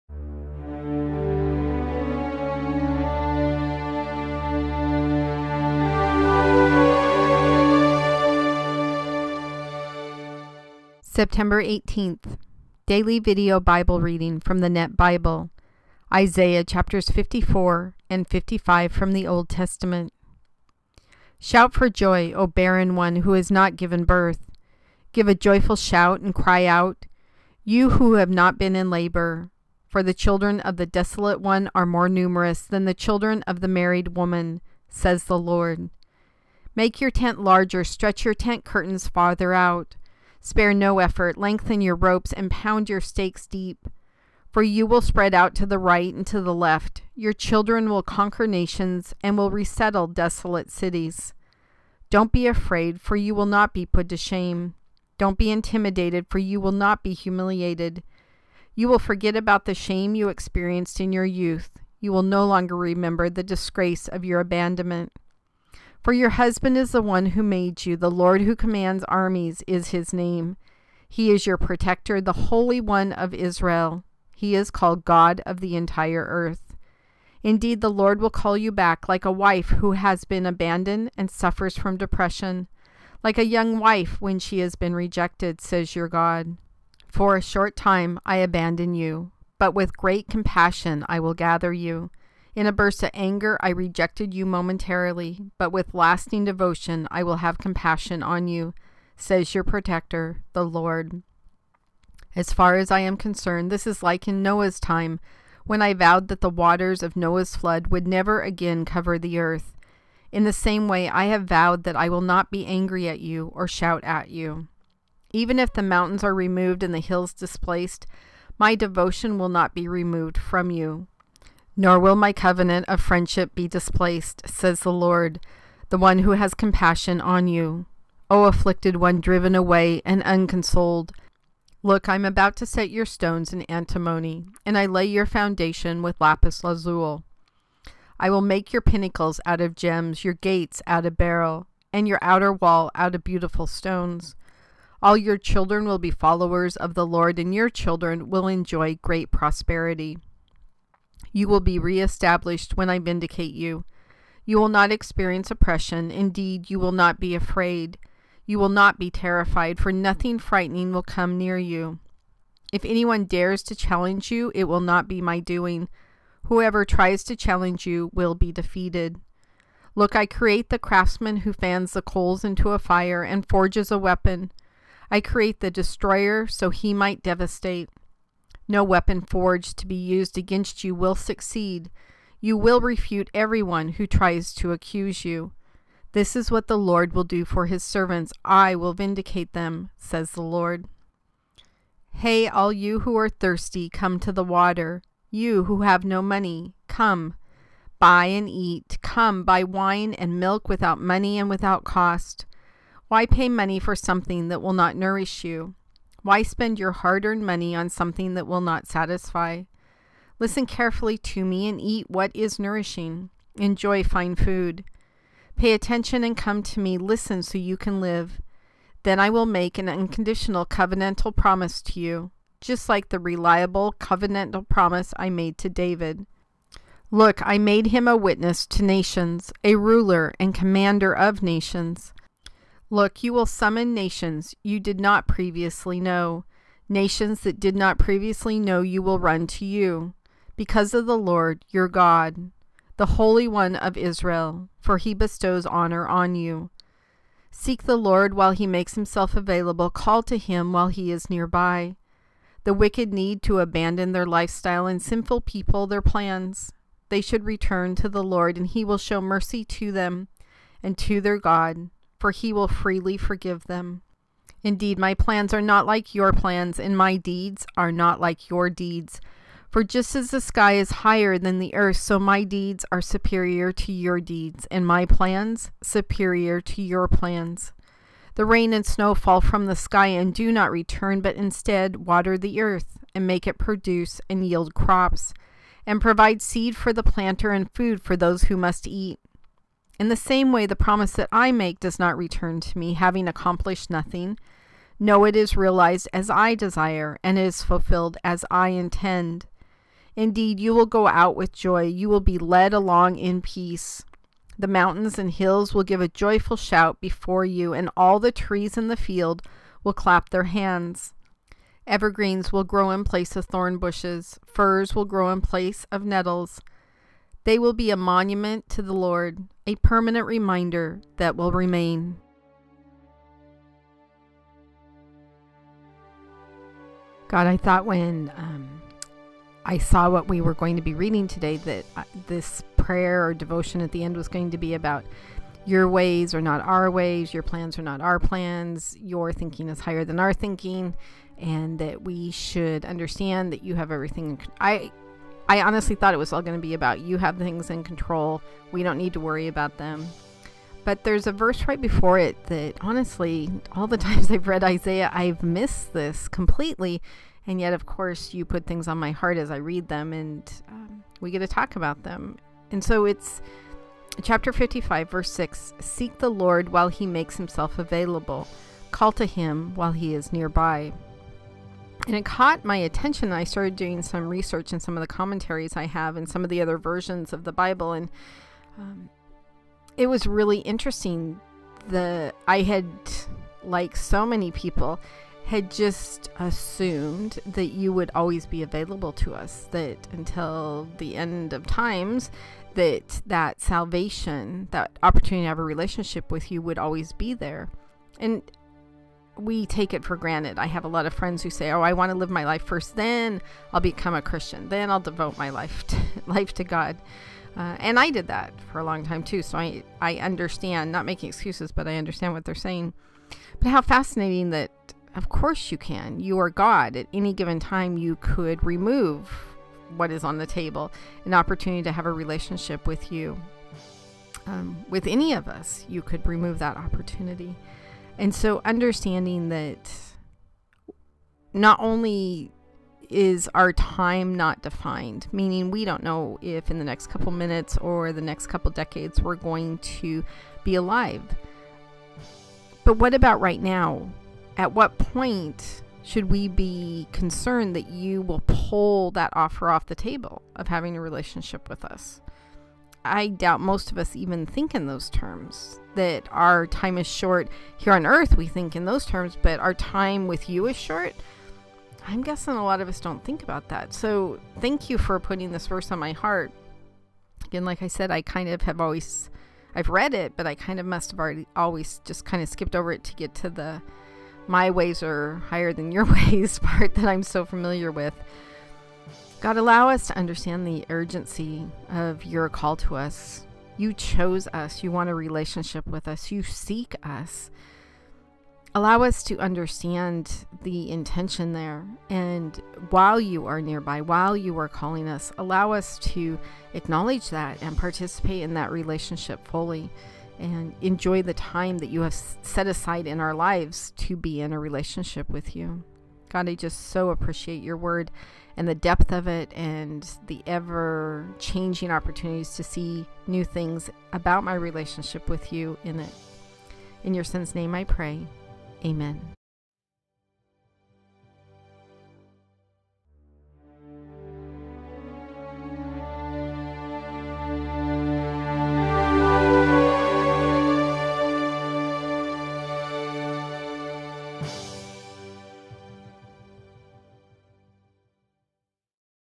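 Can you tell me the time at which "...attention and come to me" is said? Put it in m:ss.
3:35.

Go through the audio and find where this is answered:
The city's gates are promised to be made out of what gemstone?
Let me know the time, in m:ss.
2:21.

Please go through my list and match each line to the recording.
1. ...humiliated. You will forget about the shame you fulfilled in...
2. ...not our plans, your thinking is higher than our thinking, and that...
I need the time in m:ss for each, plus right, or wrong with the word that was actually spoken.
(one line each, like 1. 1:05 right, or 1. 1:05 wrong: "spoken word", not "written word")
1. 0:57 wrong: "experienced", not "fulfilled"
2. 5:37 right.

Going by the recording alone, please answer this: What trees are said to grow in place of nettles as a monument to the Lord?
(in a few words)
firs.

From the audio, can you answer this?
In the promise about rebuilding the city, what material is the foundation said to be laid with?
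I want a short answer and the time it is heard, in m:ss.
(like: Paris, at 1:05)
lapis lazuli, at 2:16.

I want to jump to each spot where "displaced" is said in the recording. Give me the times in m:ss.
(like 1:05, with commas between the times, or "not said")
1:57, 2:03.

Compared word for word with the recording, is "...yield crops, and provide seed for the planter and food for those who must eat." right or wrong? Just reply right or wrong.
right.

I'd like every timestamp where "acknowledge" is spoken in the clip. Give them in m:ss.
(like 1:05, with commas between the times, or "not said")
8:16.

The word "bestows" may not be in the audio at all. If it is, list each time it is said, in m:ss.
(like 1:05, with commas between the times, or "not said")
4:05.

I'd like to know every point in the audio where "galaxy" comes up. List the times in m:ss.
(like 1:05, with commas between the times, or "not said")
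not said.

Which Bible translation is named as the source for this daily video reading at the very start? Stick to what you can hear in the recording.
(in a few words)
Net Bible.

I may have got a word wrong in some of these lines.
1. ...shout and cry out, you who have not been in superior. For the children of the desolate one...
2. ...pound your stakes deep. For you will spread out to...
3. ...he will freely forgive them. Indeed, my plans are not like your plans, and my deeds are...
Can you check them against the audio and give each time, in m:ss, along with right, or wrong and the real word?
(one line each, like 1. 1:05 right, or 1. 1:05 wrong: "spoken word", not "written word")
1. 0:25 wrong: "labor", not "superior"
2. 0:42 right
3. 4:22 right.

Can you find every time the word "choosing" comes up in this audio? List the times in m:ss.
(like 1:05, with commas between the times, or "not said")
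not said.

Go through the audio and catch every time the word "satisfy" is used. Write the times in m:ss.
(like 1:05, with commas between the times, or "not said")
3:28.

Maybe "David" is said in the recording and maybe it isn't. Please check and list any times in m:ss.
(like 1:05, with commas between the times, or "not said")
3:45.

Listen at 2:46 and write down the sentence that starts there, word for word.
Whoever tries to challenge you will be defeated.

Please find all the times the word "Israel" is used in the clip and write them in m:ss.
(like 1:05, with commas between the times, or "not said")
1:13, 4:03.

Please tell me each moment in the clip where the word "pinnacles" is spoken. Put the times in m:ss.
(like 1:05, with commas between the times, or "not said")
2:18.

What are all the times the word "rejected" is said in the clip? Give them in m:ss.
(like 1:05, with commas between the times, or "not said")
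1:24, 1:33.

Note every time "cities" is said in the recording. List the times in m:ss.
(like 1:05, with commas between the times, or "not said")
0:50.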